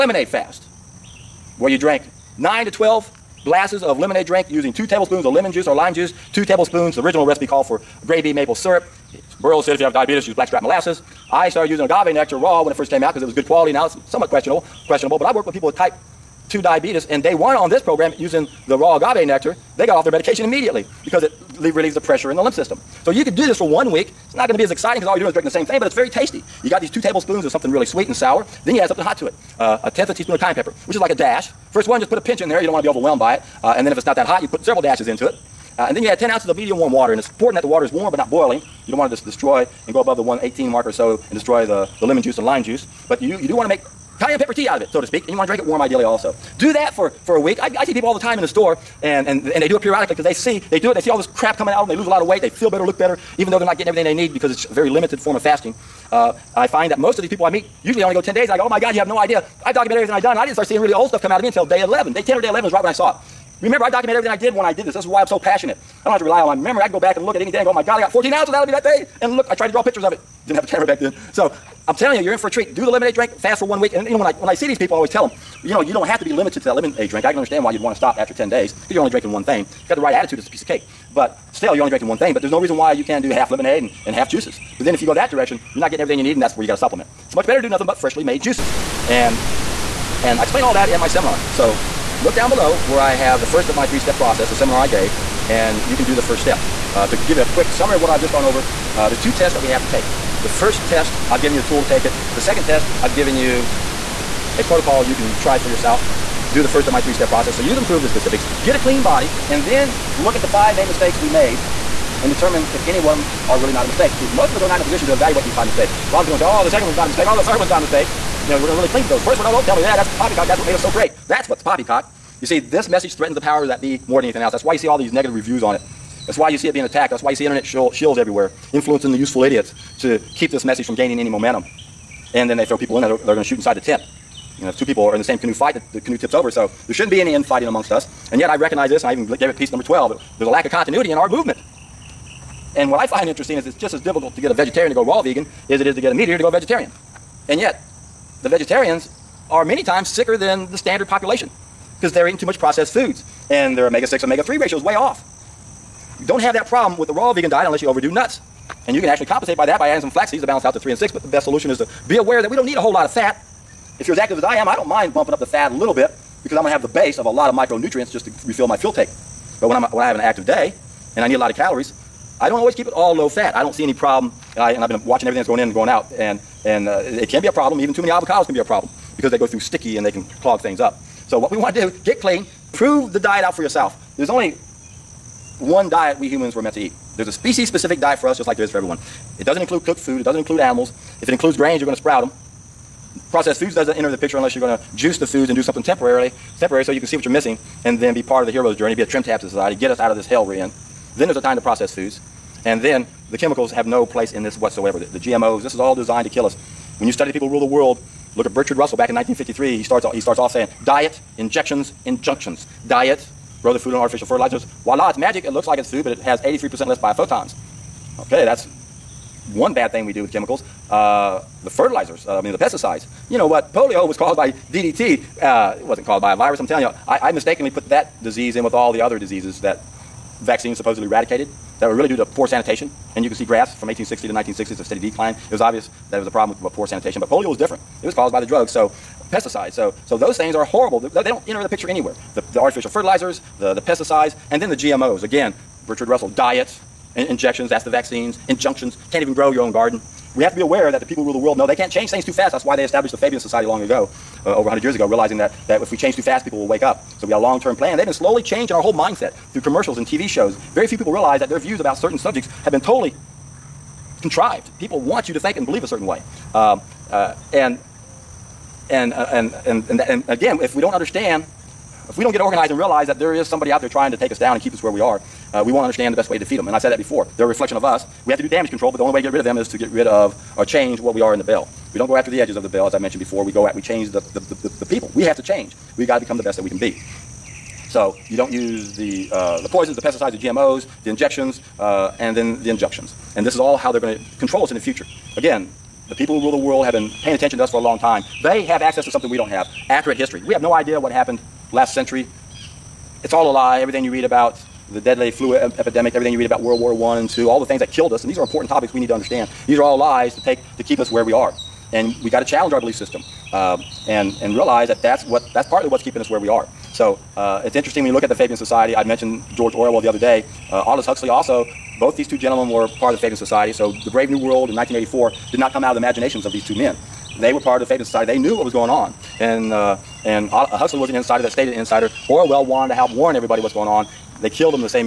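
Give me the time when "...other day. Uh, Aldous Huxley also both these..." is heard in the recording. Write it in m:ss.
5:20.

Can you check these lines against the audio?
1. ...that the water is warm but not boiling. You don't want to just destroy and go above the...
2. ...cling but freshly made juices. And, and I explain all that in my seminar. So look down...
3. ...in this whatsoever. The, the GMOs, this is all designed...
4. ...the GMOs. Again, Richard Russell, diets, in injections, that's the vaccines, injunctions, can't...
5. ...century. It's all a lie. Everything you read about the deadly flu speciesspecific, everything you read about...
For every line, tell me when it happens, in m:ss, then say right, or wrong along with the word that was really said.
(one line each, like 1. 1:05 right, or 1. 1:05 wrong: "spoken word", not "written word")
1. 0:37 right
2. 1:27 wrong: "nothing", not "cling"
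3. 3:24 right
4. 4:04 right
5. 5:01 wrong: "epidemic", not "speciesspecific".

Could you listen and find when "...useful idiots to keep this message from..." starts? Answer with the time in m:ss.
2:09.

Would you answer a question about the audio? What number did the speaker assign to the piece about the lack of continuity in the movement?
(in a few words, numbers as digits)
12.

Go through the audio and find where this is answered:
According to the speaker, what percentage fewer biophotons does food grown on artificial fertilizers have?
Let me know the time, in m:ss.
3:36.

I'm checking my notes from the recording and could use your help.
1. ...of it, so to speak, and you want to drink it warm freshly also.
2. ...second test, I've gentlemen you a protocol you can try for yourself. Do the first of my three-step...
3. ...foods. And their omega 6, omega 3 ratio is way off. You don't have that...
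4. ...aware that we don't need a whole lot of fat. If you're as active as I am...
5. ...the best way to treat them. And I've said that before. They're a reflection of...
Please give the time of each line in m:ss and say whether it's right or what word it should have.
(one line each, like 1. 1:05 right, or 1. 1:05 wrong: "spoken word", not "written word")
1. 0:44 wrong: "ideally", not "freshly"
2. 1:42 wrong: "given", not "gentlemen"
3. 2:32 right
4. 2:42 right
5. 4:36 wrong: "defeat", not "treat".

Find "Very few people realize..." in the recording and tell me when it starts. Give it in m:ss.
4:20.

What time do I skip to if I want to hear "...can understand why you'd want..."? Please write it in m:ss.
1:17.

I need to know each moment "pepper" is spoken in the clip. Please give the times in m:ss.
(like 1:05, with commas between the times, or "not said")
0:30, 0:44.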